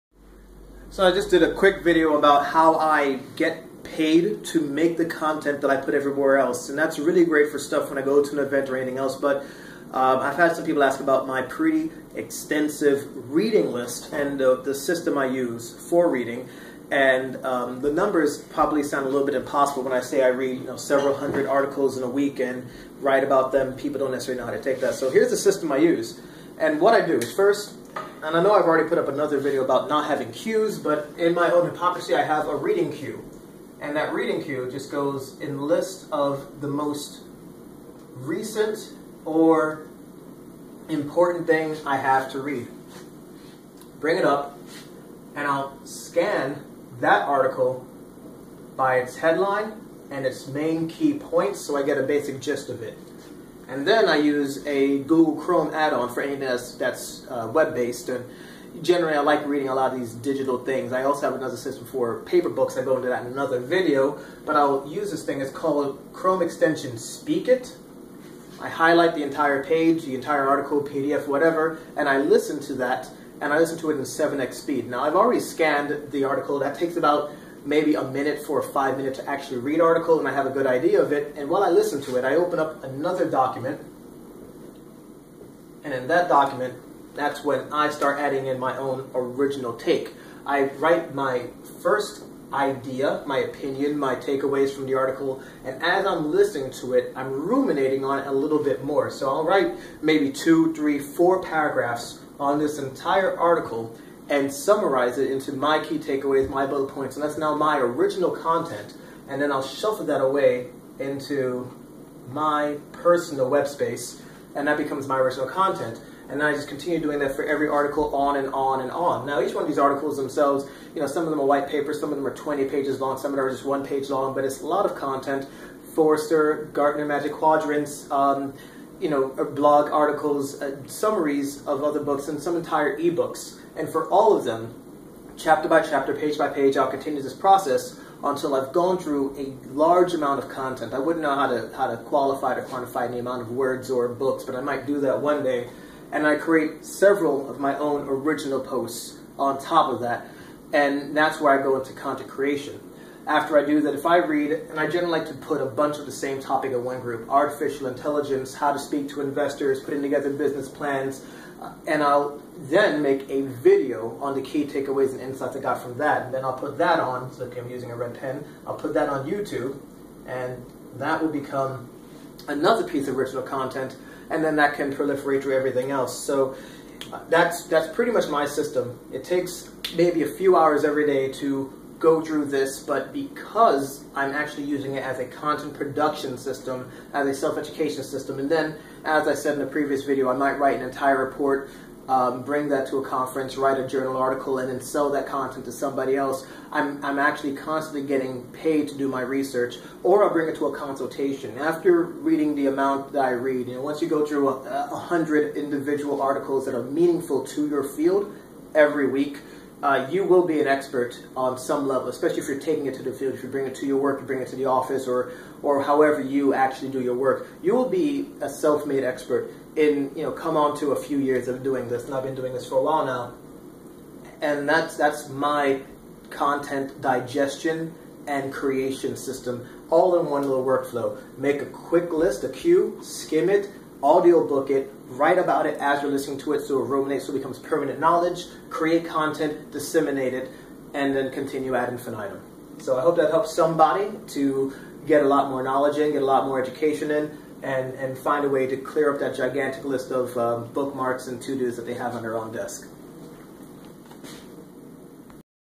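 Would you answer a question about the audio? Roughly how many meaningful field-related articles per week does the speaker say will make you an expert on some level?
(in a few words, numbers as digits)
100.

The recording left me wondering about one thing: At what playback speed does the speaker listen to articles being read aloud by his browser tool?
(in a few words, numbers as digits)
7x.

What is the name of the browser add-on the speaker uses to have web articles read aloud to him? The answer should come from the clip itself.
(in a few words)
Speak It.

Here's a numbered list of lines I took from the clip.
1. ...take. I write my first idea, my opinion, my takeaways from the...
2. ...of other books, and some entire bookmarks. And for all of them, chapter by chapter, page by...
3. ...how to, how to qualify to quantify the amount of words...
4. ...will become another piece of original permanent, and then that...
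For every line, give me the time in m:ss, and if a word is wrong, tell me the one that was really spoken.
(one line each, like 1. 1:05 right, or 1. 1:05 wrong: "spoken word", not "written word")
1. 1:29 right
2. 2:11 wrong: "ebooks", not "bookmarks"
3. 2:21 right
4. 2:51 wrong: "content", not "permanent".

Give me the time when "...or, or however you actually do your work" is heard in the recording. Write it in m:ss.
3:35.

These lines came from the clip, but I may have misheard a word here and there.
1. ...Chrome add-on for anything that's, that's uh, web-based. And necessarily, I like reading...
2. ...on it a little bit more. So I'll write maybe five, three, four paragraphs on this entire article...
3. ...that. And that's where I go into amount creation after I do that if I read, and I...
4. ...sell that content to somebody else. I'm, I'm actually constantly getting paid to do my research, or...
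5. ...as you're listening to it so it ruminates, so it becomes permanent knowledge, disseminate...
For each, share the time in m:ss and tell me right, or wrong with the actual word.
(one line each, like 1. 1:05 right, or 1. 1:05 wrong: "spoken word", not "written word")
1. 0:55 wrong: "generally", not "necessarily"
2. 1:38 wrong: "two", not "five"
3. 2:30 wrong: "content", not "amount"
4. 3:14 right
5. 3:55 wrong: "create", not "disseminate".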